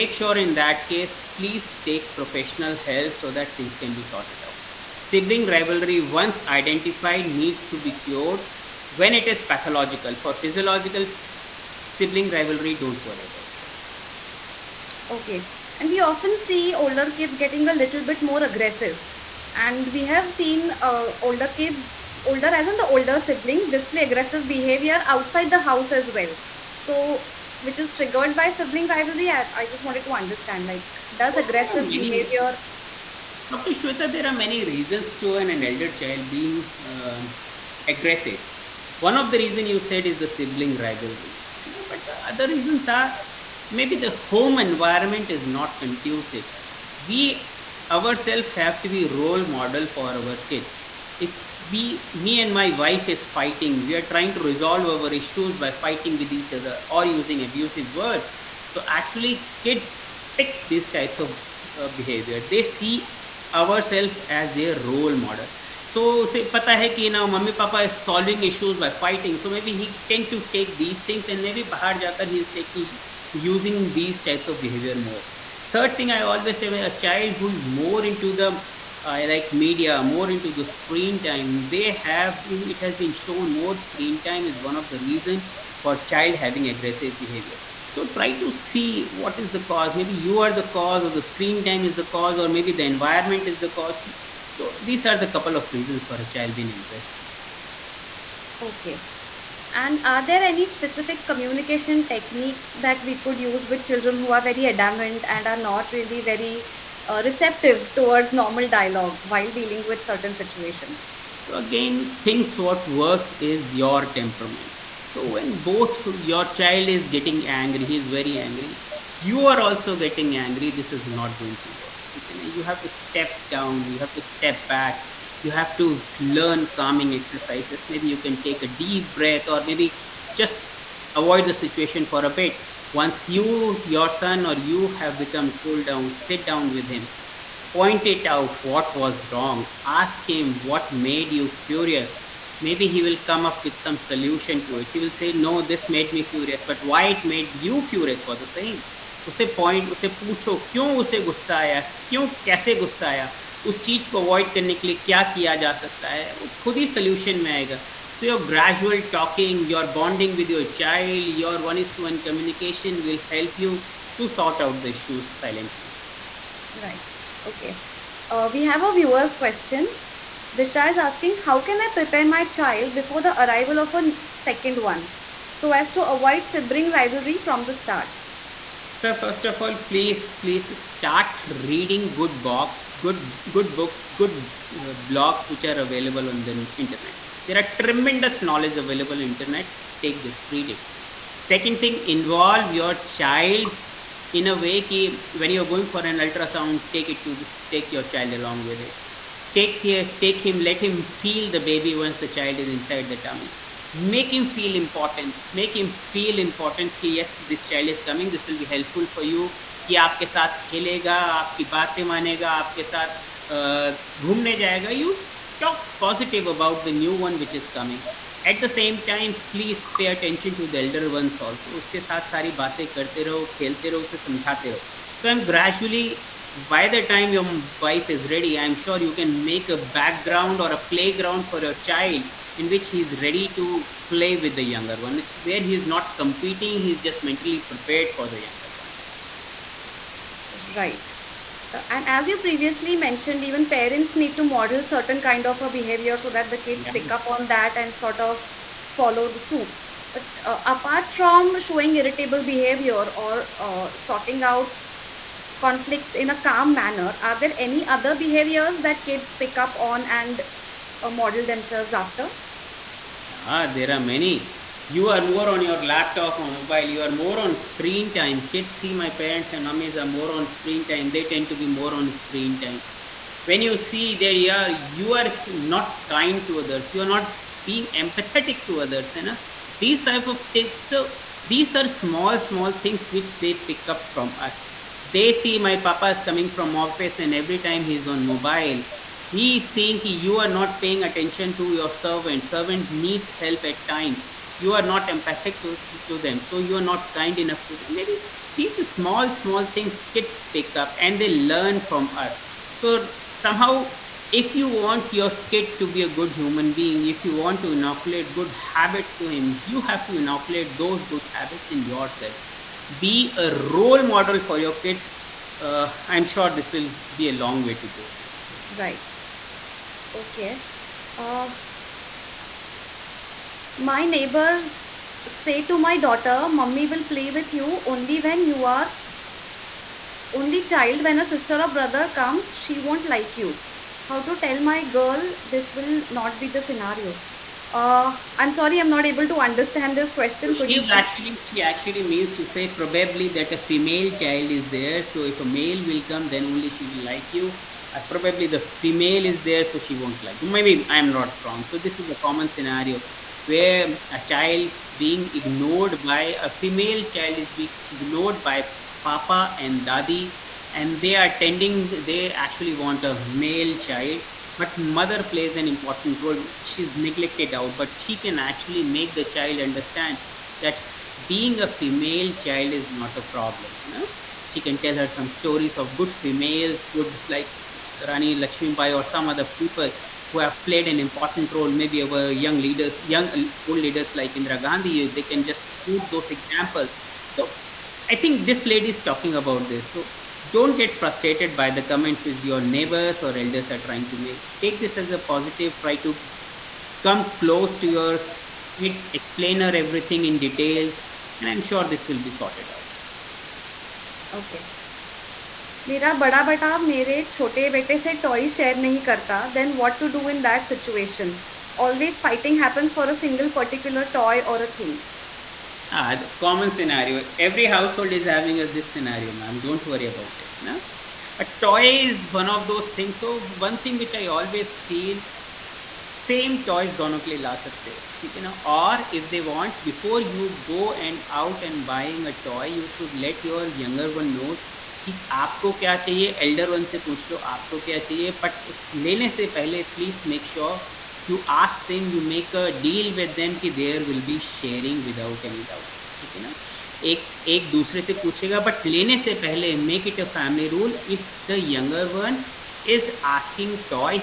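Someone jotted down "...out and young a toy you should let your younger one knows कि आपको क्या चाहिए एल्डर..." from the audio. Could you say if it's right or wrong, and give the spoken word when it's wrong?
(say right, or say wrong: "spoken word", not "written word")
wrong: "buying", not "young".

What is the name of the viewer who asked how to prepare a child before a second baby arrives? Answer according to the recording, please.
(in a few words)
Disha.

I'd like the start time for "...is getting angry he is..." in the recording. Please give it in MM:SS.
01:56.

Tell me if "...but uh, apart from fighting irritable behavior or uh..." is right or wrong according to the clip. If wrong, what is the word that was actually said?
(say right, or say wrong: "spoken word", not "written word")
wrong: "showing", not "fighting".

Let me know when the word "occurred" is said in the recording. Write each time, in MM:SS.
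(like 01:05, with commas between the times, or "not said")
not said.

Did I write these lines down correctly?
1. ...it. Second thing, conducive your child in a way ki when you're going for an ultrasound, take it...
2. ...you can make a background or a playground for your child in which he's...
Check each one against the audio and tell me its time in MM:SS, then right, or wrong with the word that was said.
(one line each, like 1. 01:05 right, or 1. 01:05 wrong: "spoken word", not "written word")
1. 03:10 wrong: "involve", not "conducive"
2. 03:49 right.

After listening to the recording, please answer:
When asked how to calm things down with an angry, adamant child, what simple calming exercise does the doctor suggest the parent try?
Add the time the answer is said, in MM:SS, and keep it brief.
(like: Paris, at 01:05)
Take a deep breath, at 02:08.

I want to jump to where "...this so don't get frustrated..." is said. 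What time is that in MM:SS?
06:29.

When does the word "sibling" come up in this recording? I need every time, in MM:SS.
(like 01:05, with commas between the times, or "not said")
00:04, 00:11, 00:23, 00:28, 00:40, 02:56.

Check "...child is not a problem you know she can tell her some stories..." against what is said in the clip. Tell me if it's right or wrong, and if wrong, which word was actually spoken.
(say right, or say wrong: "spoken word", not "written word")
right.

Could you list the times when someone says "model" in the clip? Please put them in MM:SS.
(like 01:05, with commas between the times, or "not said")
00:49, 01:05, 04:04, 04:21, 05:14.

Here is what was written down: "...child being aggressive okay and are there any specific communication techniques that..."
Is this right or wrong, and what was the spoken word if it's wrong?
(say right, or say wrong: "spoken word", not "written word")
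right.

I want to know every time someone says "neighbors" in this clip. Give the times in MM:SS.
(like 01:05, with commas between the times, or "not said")
05:24, 06:32.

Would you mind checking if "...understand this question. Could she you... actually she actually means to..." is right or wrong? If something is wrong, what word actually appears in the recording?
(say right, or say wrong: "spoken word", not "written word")
right.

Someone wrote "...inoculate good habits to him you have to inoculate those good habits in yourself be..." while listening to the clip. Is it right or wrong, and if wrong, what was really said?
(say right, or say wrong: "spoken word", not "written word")
right.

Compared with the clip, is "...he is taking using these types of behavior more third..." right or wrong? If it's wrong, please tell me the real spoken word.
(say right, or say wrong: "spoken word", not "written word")
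right.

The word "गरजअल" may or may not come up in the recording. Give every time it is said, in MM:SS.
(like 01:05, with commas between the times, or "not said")
02:38, 03:45.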